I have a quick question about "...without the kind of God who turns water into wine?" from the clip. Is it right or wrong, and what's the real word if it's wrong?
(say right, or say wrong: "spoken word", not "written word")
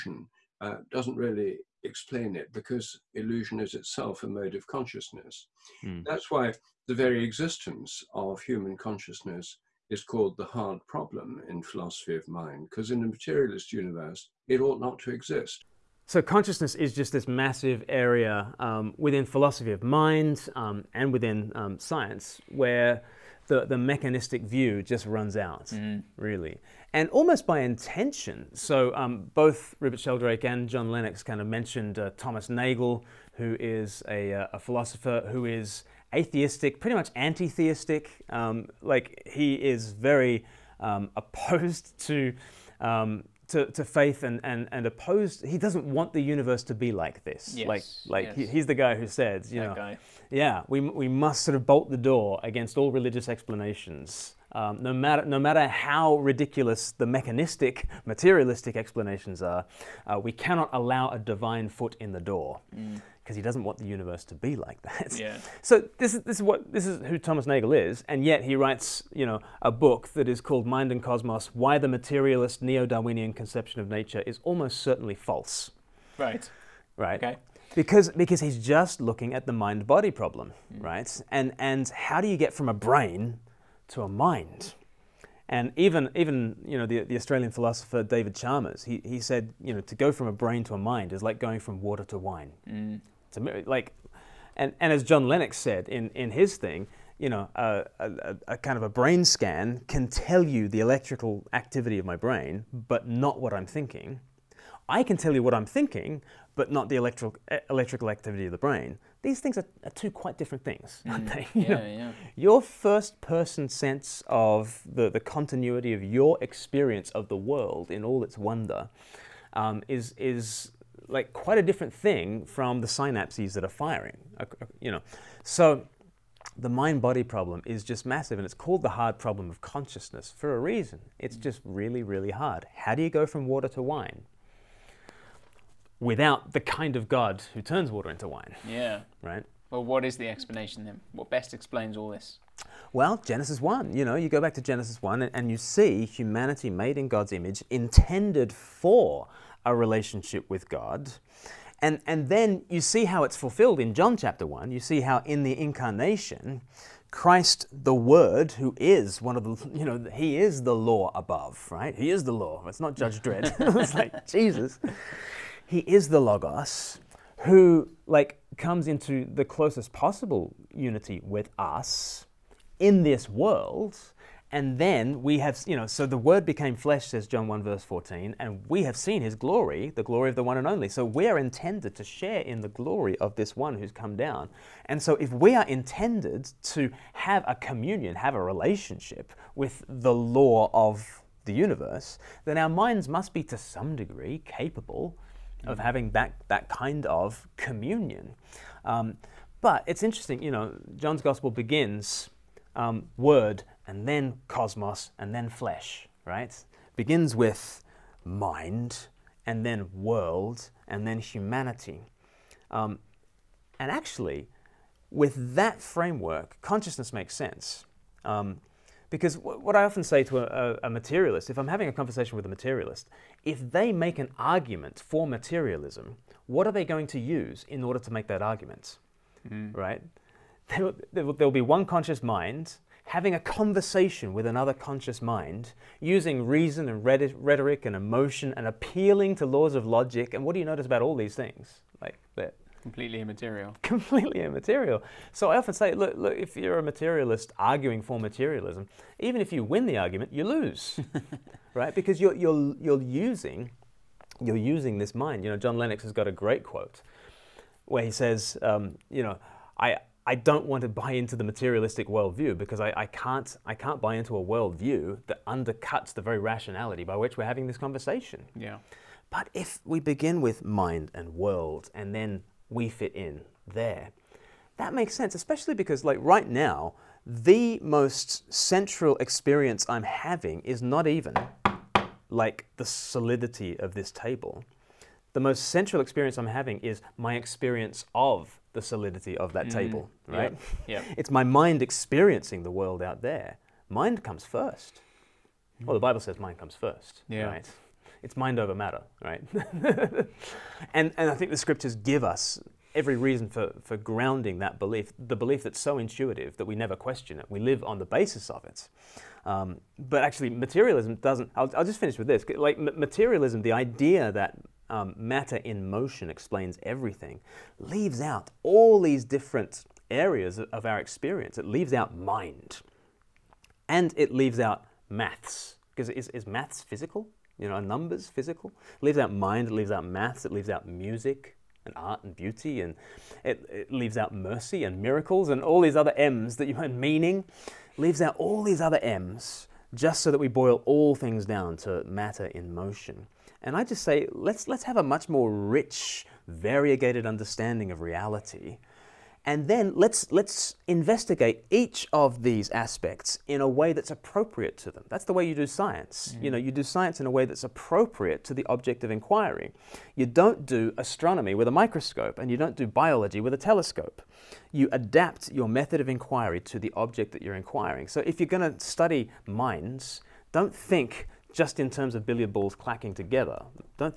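right.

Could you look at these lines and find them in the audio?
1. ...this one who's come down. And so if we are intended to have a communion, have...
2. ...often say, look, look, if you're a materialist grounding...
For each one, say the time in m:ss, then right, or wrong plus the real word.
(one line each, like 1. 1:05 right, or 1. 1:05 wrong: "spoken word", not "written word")
1. 3:03 right
2. 4:05 wrong: "arguing", not "grounding".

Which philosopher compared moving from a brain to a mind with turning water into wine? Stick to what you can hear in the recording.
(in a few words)
David Chalmers.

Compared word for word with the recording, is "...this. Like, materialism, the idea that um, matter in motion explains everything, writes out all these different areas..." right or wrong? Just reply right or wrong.
wrong.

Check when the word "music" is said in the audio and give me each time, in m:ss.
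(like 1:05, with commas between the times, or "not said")
5:30.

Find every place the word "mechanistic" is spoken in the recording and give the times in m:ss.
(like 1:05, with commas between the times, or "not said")
0:23, 0:57.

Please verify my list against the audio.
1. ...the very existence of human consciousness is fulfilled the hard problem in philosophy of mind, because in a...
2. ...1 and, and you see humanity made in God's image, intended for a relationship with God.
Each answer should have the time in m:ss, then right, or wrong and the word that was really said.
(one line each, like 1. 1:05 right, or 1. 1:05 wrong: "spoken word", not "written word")
1. 0:06 wrong: "called", not "fulfilled"
2. 2:25 right.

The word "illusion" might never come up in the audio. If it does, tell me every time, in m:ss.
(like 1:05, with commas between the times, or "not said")
0:03.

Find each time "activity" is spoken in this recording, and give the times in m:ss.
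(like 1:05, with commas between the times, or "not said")
1:41, 1:48.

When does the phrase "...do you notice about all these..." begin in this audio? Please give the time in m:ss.
4:00.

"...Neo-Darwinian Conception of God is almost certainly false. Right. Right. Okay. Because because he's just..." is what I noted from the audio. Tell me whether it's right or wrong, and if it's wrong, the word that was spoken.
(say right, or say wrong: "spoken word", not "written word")
wrong: "Nature", not "God".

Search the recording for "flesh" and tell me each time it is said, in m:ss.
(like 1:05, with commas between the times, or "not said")
2:56, 3:25.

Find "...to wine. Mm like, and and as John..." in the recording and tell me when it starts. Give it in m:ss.
1:32.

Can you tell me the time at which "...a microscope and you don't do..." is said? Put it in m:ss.
6:01.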